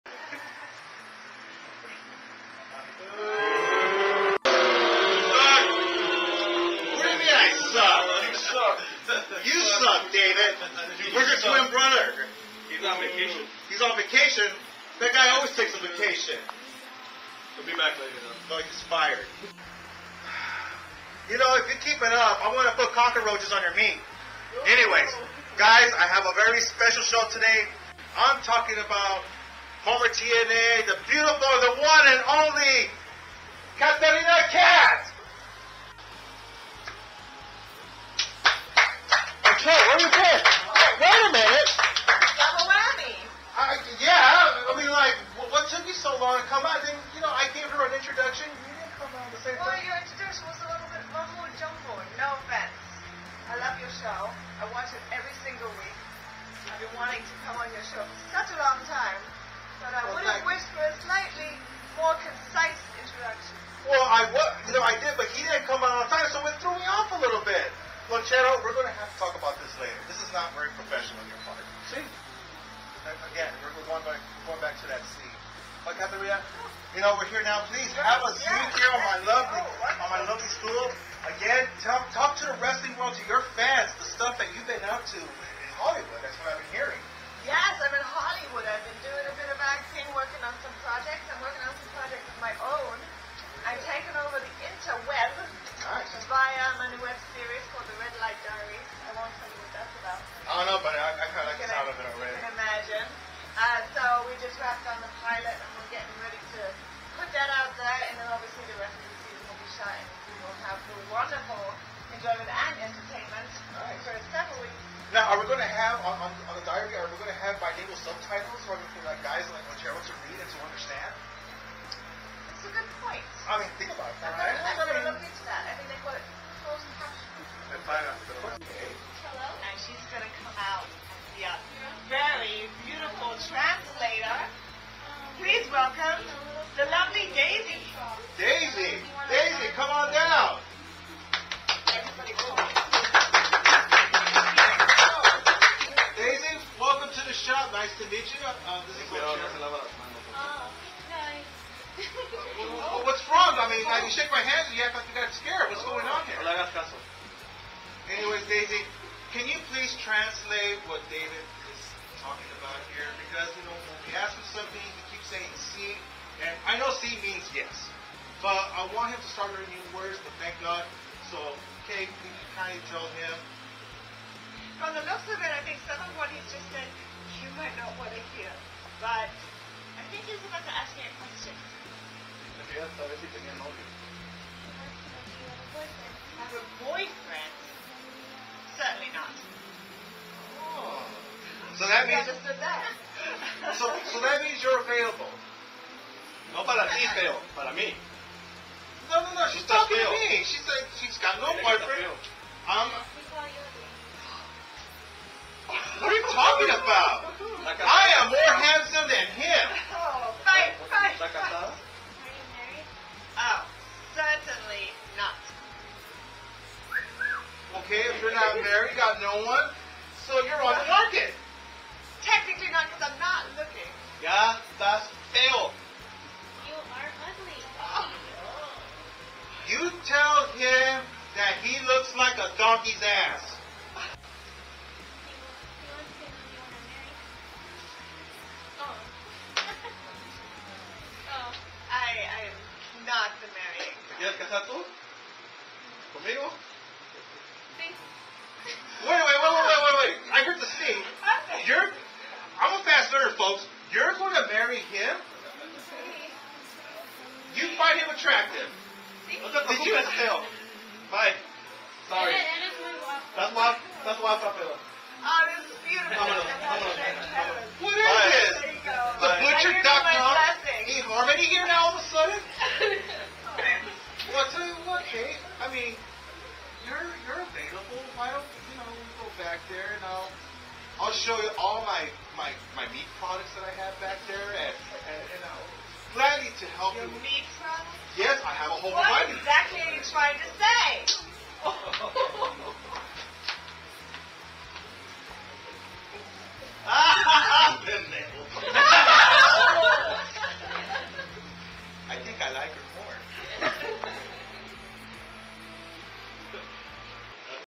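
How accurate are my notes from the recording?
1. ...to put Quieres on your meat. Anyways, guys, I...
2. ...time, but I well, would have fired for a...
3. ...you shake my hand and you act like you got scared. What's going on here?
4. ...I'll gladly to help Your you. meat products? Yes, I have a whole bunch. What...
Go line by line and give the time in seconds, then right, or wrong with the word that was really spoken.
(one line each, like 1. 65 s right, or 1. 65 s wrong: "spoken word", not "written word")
1. 22 s wrong: "cockroaches", not "Quieres"
2. 58 s wrong: "wished", not "fired"
3. 153 s right
4. 285 s right.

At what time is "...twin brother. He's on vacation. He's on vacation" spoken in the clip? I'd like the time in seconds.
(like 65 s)
11 s.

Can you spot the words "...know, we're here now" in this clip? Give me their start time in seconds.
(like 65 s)
77 s.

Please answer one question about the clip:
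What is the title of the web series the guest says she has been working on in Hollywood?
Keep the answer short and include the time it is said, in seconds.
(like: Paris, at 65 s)
The Red Light Diaries, at 97 s.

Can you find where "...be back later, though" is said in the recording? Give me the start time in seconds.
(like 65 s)
17 s.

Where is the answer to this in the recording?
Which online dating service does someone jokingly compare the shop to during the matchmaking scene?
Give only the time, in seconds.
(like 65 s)
270 s.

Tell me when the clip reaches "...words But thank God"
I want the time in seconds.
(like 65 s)
170 s.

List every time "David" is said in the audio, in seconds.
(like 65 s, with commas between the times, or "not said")
10 s, 161 s.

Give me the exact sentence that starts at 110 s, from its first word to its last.
we will have the wonderful enjoyment and entertainment right.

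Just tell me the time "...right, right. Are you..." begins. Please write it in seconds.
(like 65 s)
210 s.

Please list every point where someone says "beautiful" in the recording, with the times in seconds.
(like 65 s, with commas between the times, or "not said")
31 s, 265 s.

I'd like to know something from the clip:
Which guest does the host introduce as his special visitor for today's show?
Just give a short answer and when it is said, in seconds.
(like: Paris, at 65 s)
Katarina Katz, at 33 s.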